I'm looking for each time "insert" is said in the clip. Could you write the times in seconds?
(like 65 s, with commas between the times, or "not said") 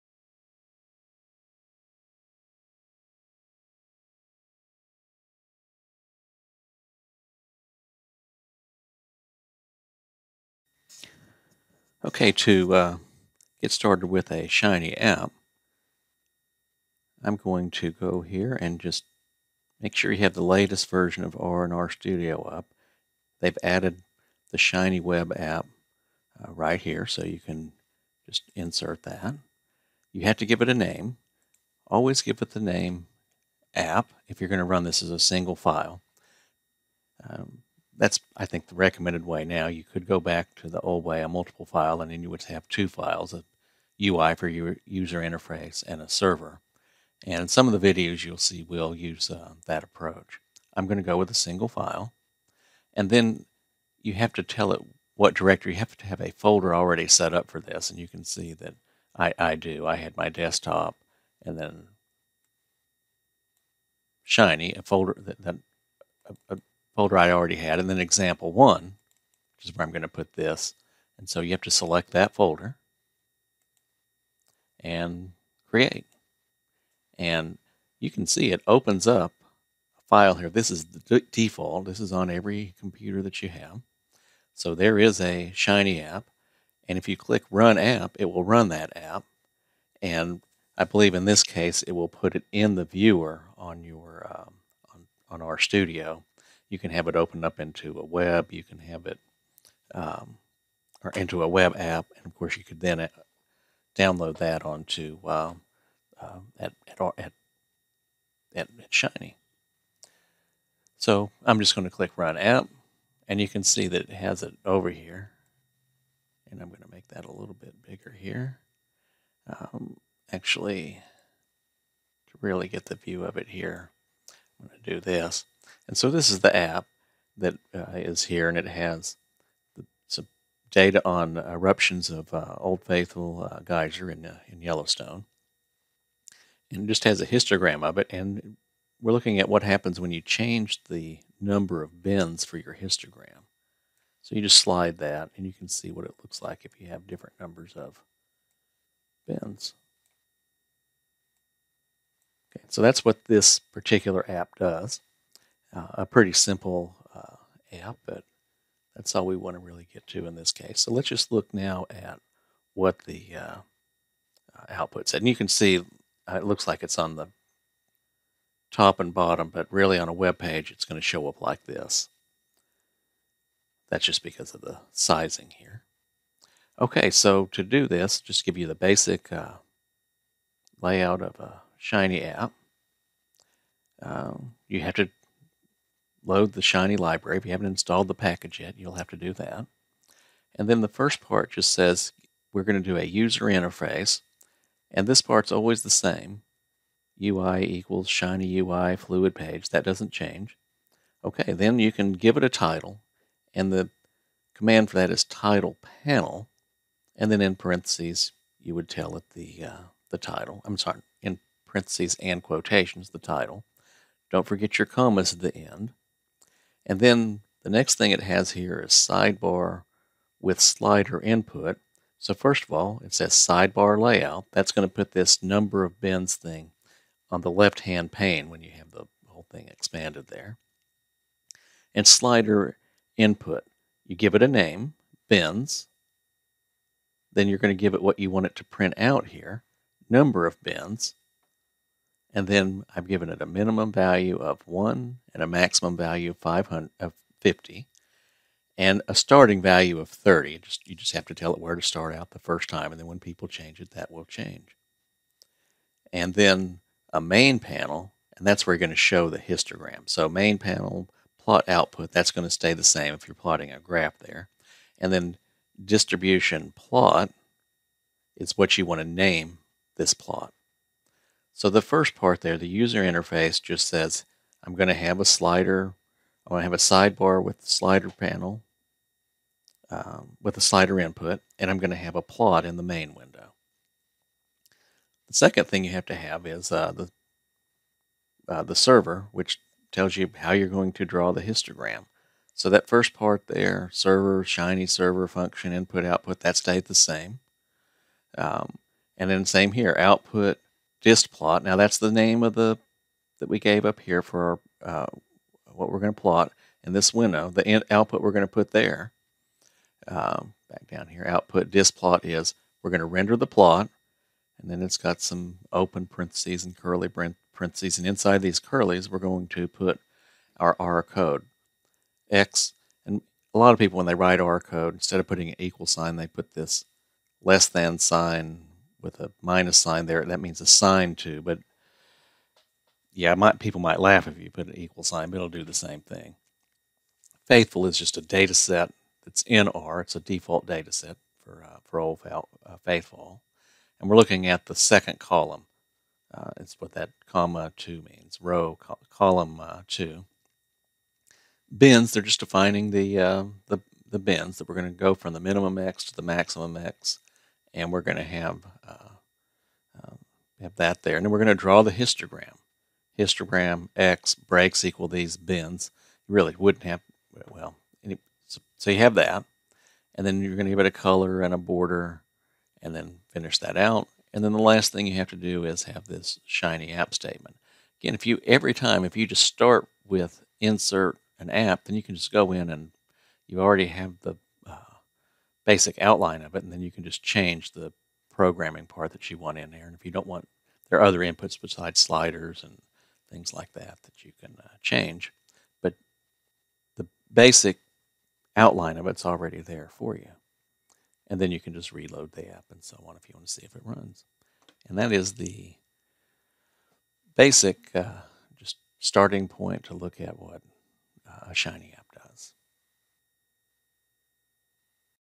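28 s, 380 s.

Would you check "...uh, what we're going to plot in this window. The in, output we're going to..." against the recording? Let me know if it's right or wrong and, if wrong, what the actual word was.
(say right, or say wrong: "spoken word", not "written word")
right.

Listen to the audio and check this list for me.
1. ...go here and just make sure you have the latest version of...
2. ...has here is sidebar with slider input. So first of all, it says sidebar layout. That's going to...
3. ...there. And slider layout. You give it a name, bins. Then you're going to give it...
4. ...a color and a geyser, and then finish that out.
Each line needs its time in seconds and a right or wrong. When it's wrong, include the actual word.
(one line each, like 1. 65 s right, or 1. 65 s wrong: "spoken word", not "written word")
1. 17 s right
2. 218 s right
3. 230 s wrong: "input", not "layout"
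4. 370 s wrong: "border", not "geyser".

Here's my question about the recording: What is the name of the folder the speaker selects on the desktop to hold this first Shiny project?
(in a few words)
example one.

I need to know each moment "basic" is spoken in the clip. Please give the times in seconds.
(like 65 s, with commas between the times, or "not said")
178 s, 385 s, 397 s, 407 s.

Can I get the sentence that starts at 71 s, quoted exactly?
And so you have to select that folder and create.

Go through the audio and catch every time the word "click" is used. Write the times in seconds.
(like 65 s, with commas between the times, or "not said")
87 s, 111 s.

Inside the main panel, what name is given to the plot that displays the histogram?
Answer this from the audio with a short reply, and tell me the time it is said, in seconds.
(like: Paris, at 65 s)
distribution plot, at 265 s.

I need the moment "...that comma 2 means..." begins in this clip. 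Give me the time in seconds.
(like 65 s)
346 s.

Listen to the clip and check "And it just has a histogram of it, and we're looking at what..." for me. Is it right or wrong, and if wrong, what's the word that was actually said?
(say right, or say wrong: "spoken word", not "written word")
right.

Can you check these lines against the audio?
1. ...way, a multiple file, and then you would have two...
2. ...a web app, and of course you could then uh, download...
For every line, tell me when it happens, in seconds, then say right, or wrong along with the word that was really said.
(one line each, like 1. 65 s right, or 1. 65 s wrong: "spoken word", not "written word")
1. 41 s right
2. 101 s right.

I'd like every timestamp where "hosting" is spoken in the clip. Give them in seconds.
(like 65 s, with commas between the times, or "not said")
not said.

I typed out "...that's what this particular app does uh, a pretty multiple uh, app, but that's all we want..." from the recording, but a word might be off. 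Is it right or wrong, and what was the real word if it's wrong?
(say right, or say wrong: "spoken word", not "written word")
wrong: "simple", not "multiple".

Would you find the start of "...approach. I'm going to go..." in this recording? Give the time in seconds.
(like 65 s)
49 s.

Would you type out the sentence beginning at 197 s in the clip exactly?
UI equals Shiny UI fluid page.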